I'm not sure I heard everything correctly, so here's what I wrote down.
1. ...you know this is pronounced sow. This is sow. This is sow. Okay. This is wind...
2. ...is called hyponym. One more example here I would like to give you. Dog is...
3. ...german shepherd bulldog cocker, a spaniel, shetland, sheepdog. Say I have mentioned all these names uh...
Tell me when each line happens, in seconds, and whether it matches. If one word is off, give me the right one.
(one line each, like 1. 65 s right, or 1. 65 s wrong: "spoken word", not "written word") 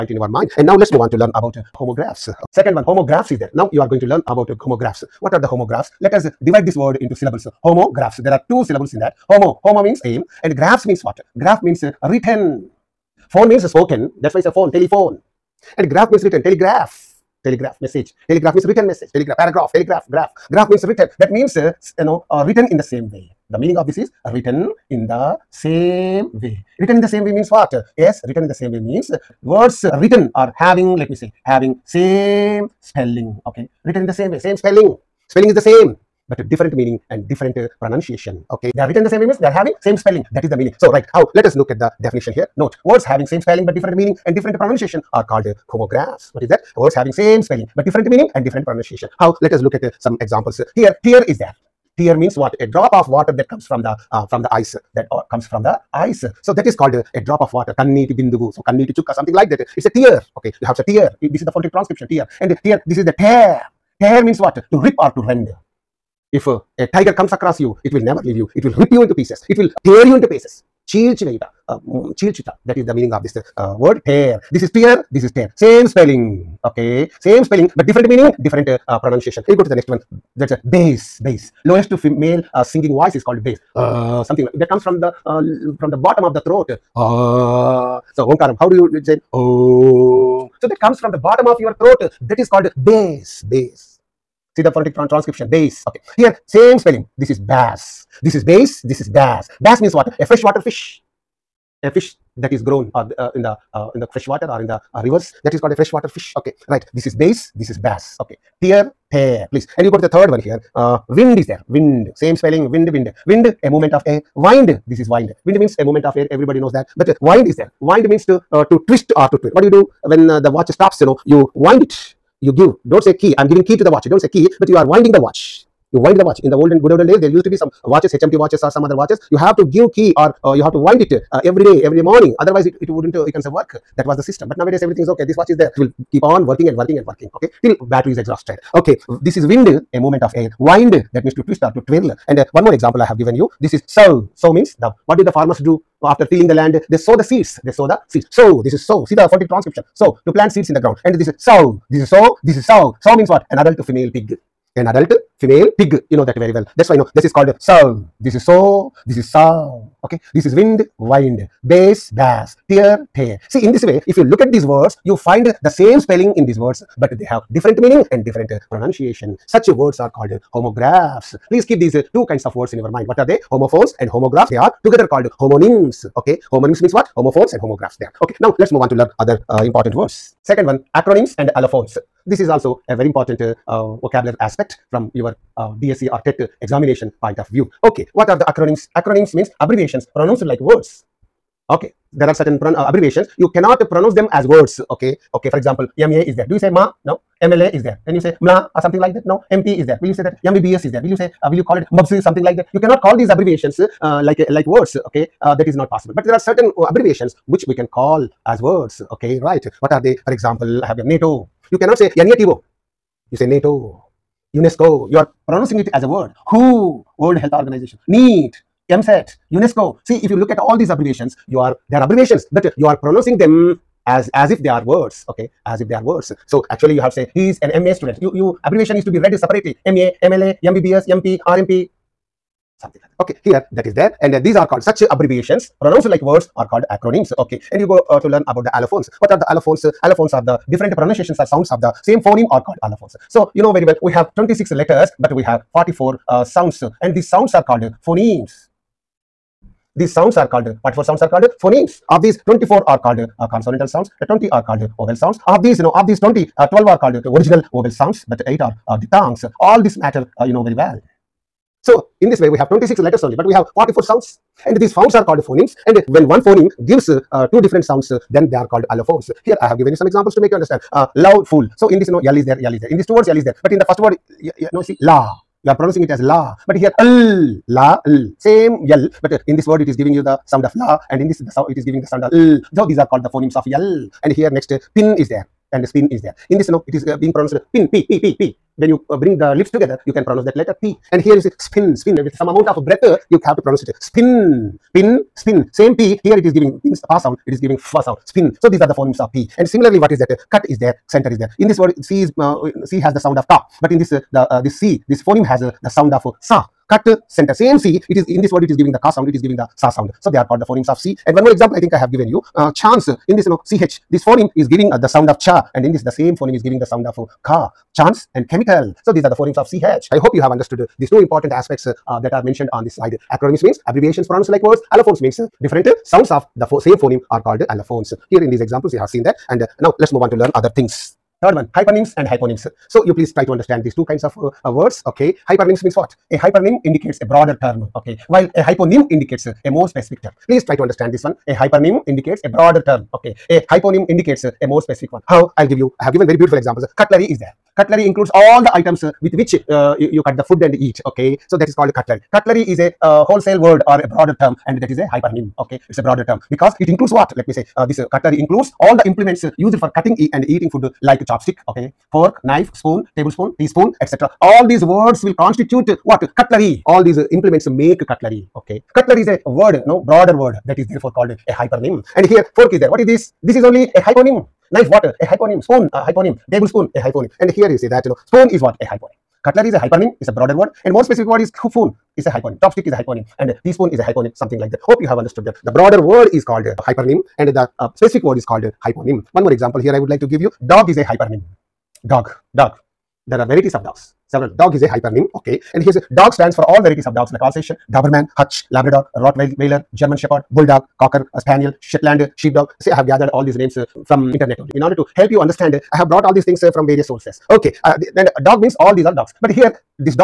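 1. 156 s wrong: "called", not "pronounced"
2. 388 s right
3. 400 s wrong: "gathered", not "mentioned".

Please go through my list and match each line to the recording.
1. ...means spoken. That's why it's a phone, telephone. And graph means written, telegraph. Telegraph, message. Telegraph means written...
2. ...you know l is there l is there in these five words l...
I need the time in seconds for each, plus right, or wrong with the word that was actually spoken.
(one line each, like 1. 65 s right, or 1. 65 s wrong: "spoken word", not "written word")
1. 13 s right
2. 272 s wrong: "two", not "five".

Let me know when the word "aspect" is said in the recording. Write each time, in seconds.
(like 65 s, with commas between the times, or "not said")
184 s, 321 s.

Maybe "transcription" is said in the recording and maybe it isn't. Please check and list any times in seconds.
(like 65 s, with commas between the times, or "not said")
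61 s, 94 s, 149 s.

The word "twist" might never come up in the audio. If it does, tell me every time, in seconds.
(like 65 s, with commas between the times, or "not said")
118 s, 141 s.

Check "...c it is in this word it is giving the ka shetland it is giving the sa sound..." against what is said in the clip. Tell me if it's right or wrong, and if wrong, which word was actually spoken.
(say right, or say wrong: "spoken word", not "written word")
wrong: "sound", not "shetland".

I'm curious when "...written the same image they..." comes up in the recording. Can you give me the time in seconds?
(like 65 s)
38 s.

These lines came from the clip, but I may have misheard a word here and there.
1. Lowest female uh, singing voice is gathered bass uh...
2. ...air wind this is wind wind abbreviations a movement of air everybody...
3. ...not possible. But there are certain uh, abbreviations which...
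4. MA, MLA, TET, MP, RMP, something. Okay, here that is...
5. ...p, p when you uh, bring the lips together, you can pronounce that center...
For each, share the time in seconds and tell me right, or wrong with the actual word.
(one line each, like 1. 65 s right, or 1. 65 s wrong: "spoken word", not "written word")
1. 81 s wrong: "called", not "gathered"
2. 114 s wrong: "means", not "abbreviations"
3. 205 s right
4. 229 s wrong: "MBBS", not "TET"
5. 288 s wrong: "letter", not "center".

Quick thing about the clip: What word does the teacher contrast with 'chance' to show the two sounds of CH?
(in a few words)
Chemical.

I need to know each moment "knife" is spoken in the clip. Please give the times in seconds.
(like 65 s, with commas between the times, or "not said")
362 s, 374 s.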